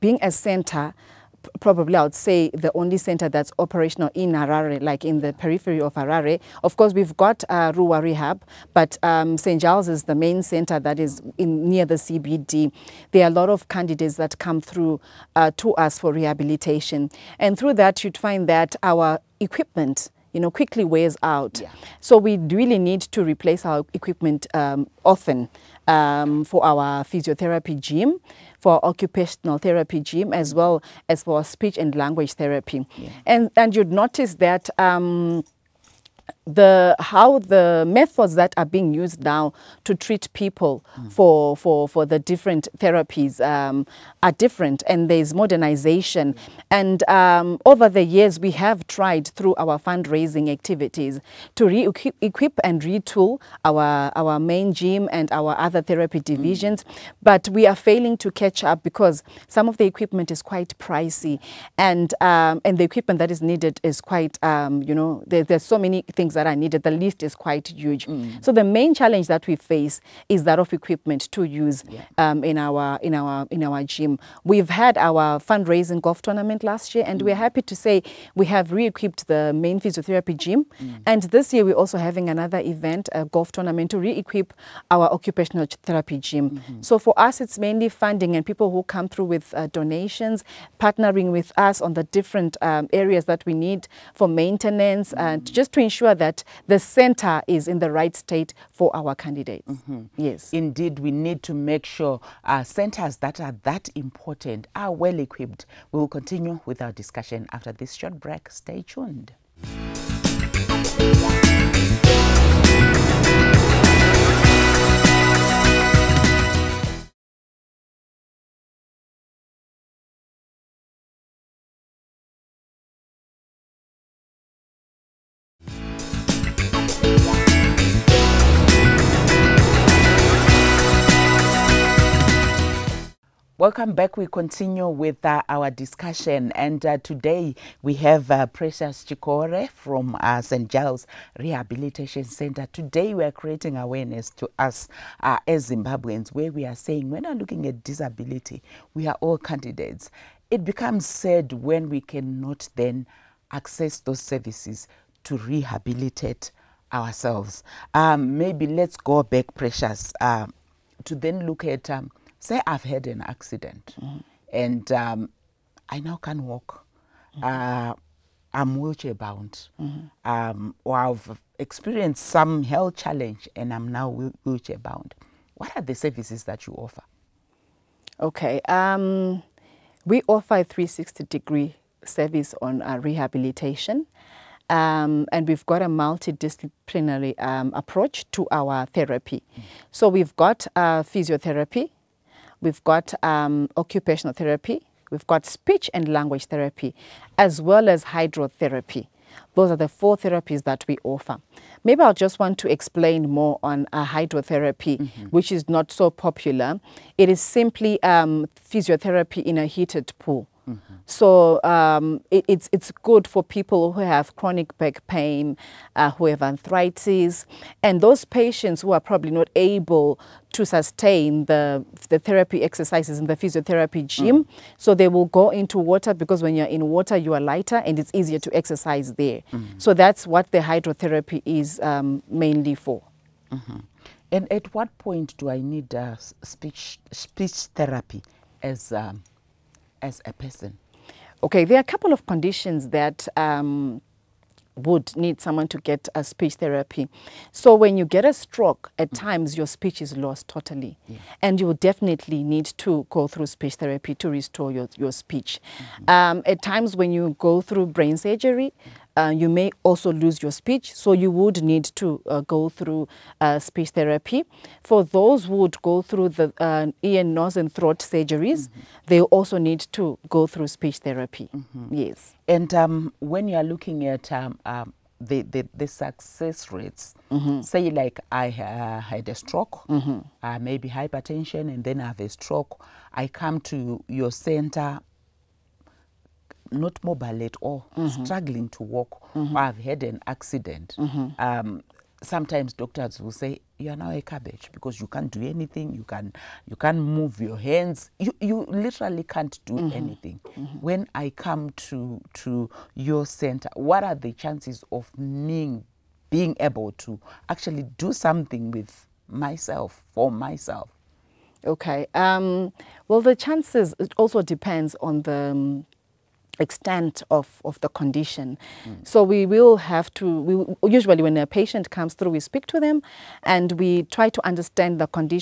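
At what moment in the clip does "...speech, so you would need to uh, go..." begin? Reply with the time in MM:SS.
04:20.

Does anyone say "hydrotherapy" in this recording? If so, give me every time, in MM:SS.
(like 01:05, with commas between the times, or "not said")
03:18, 03:24, 03:50.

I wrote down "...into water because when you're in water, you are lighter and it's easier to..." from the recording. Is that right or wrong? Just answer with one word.
right.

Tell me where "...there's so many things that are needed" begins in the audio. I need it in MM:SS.
01:05.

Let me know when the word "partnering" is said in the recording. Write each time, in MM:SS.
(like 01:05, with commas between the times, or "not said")
01:30.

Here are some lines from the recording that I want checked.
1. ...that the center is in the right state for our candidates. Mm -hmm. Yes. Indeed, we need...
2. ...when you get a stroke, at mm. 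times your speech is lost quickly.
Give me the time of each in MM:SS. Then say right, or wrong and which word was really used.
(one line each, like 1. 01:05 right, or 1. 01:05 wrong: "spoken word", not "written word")
1. 01:36 right
2. 04:07 wrong: "totally", not "quickly".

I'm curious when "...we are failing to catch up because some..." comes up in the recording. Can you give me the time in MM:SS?
00:57.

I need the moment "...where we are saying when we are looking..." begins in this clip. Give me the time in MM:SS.
02:26.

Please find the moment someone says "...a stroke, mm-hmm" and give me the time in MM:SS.
04:39.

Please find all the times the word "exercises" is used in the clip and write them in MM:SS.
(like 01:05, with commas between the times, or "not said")
03:42, 03:48.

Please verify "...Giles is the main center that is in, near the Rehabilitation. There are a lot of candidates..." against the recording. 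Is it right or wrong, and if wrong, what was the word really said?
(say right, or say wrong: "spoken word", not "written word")
wrong: "CBD", not "Rehabilitation".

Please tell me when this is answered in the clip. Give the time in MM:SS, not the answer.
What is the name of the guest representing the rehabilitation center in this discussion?
02:18.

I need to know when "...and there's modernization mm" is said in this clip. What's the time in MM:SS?
00:44.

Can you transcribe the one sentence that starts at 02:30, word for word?
It becomes sad when we cannot then access those services to rehabilitate ourselves.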